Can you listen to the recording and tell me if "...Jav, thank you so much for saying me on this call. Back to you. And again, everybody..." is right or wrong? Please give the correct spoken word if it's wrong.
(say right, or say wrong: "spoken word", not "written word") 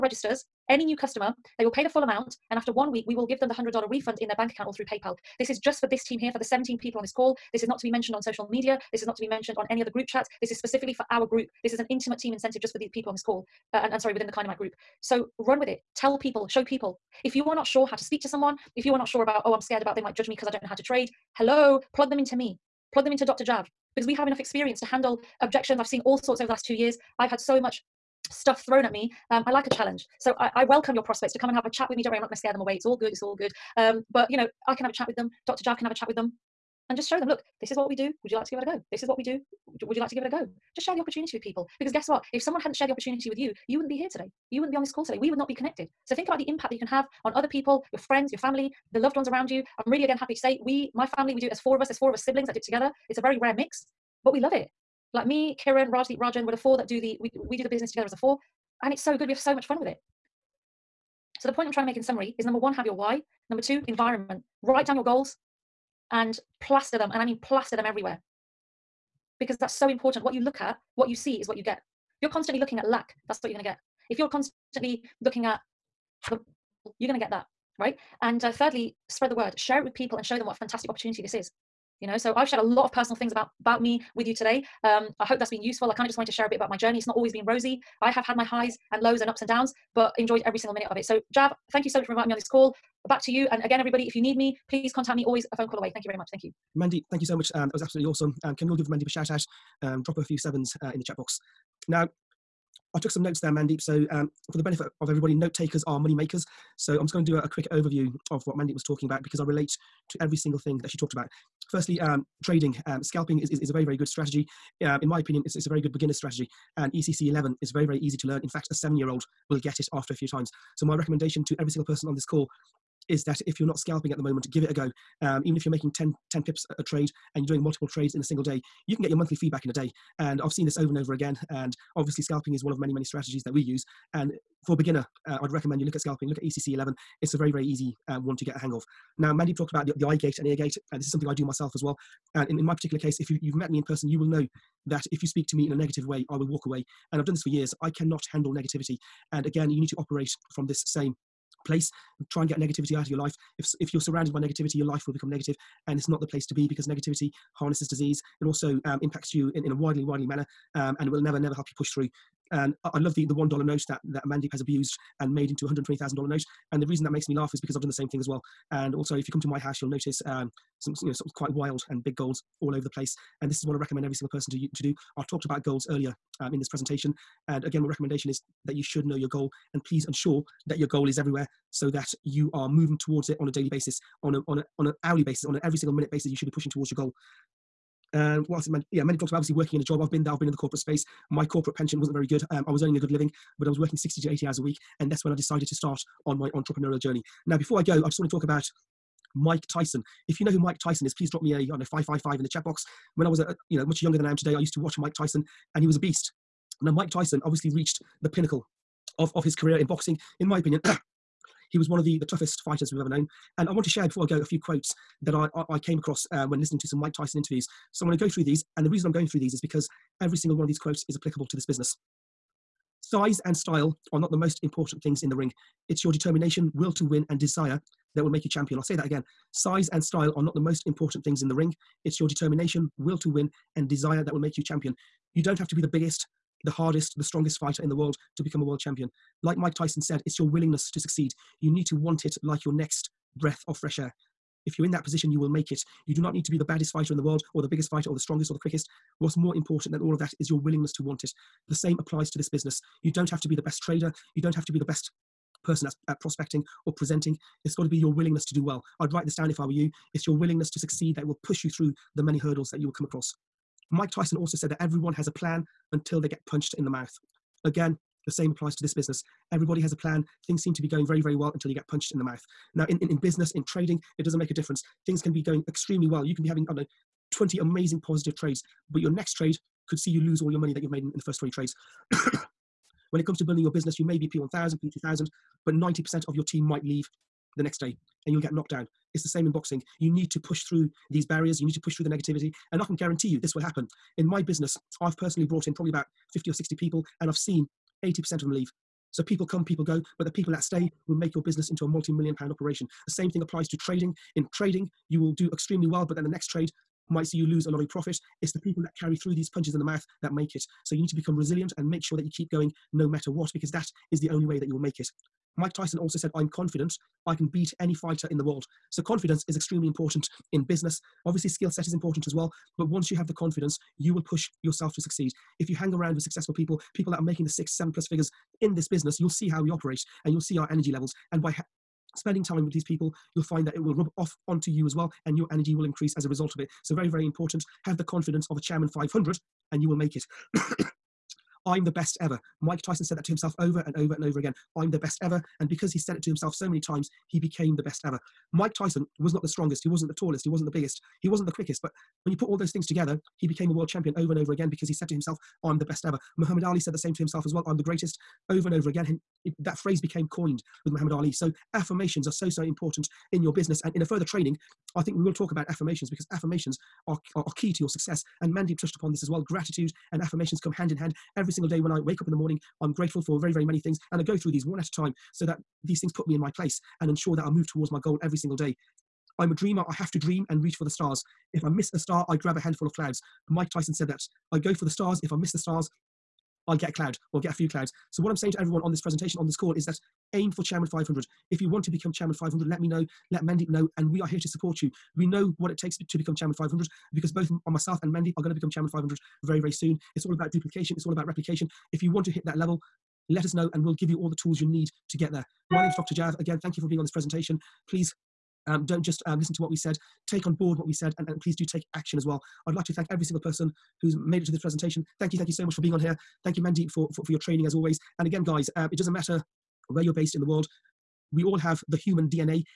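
wrong: "inviting", not "saying".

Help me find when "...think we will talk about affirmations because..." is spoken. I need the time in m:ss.
6:05.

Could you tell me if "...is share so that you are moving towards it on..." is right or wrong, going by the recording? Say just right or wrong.
wrong.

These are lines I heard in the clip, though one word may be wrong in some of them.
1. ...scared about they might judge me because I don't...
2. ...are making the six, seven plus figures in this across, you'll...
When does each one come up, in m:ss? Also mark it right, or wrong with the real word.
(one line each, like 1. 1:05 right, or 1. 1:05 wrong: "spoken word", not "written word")
1. 0:19 right
2. 5:27 wrong: "business", not "across".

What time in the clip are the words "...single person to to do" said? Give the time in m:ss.
2:54.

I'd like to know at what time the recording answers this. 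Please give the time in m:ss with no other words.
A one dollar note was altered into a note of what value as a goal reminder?
2:45.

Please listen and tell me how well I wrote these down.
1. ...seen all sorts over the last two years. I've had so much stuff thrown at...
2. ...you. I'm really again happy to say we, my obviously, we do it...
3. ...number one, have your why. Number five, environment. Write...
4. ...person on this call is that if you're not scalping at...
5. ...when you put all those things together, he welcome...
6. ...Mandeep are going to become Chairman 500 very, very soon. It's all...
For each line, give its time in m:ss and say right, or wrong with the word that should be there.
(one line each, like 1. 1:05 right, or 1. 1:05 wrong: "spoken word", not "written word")
1. 0:25 right
2. 0:49 wrong: "family", not "obviously"
3. 1:02 wrong: "two", not "five"
4. 2:01 right
5. 5:52 wrong: "became", not "welcome"
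6. 6:38 right.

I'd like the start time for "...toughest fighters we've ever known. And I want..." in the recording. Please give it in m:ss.
3:32.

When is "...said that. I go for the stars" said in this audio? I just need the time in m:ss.
6:23.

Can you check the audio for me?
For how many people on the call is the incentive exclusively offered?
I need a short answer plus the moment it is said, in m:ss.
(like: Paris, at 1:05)
17, at 0:06.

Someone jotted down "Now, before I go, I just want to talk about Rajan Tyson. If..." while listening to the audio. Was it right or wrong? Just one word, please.
wrong.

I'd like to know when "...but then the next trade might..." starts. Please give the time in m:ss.
5:06.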